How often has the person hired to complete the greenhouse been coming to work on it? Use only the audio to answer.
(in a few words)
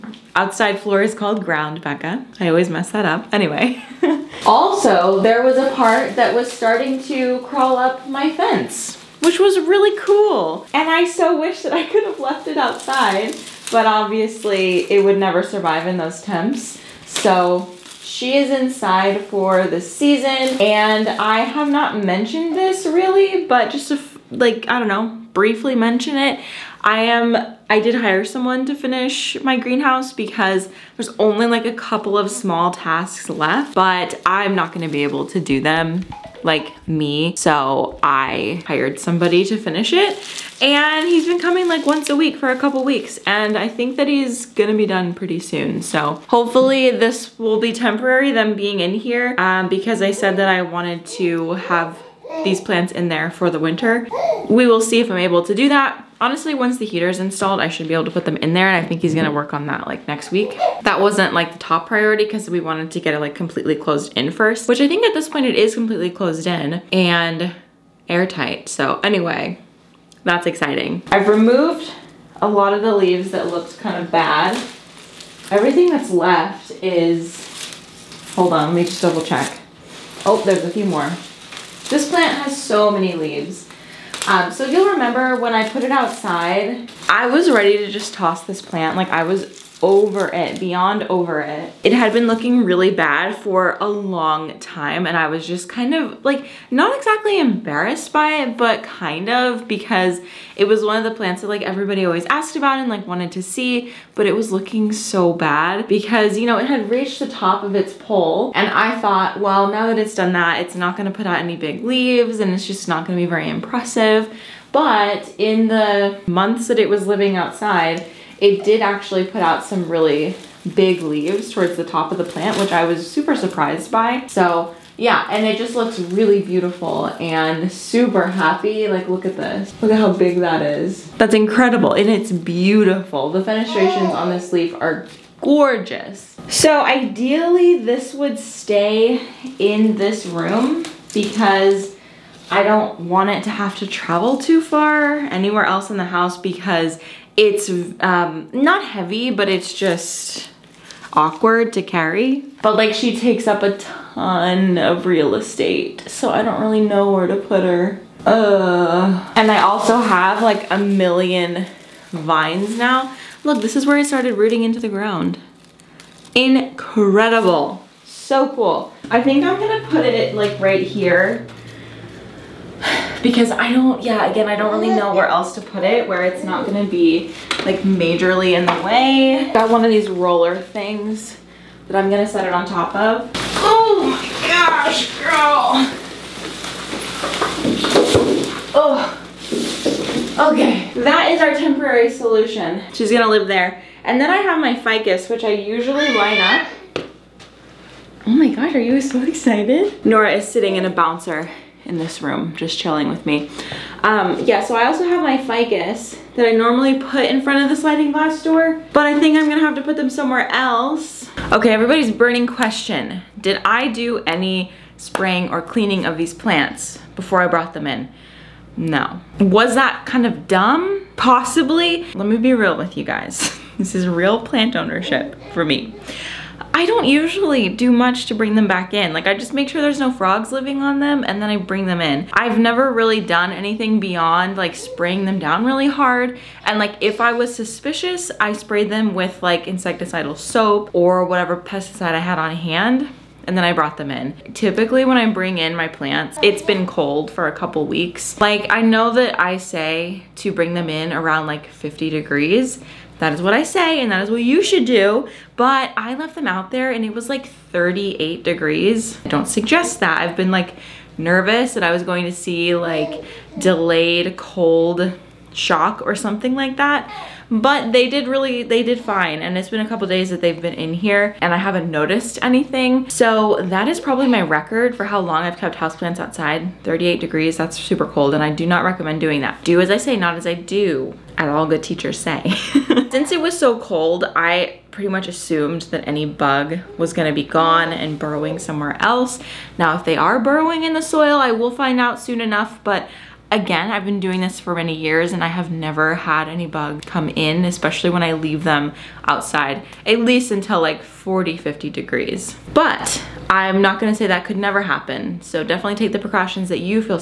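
Once a week.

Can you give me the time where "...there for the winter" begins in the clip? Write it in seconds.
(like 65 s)
53 s.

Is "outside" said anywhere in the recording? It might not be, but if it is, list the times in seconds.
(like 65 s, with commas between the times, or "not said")
0 s, 12 s, 85 s, 117 s, 276 s, 299 s.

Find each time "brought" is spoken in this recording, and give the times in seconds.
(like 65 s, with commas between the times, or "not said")
217 s, 243 s.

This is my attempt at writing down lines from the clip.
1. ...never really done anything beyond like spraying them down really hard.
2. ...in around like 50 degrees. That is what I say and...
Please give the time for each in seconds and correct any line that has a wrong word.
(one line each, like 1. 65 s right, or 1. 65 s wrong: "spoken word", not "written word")
1. 232 s right
2. 250 s right.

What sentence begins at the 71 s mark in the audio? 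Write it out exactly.
I've removed a lot of the leaves that looked kind of bad.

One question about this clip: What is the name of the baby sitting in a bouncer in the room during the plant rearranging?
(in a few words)
Nora.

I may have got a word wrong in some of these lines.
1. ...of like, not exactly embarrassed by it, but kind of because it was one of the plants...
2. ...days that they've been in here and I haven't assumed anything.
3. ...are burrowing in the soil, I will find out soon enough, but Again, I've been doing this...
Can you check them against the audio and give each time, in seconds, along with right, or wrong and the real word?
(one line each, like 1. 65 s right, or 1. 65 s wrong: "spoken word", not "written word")
1. 95 s right
2. 270 s wrong: "noticed", not "assumed"
3. 290 s right.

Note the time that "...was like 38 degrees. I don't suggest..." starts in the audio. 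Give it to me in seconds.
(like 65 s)
257 s.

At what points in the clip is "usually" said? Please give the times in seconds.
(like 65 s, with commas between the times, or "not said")
195 s, 227 s.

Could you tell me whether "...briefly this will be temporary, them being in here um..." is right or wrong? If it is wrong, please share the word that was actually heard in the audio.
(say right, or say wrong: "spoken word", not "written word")
wrong: "hopefully", not "briefly".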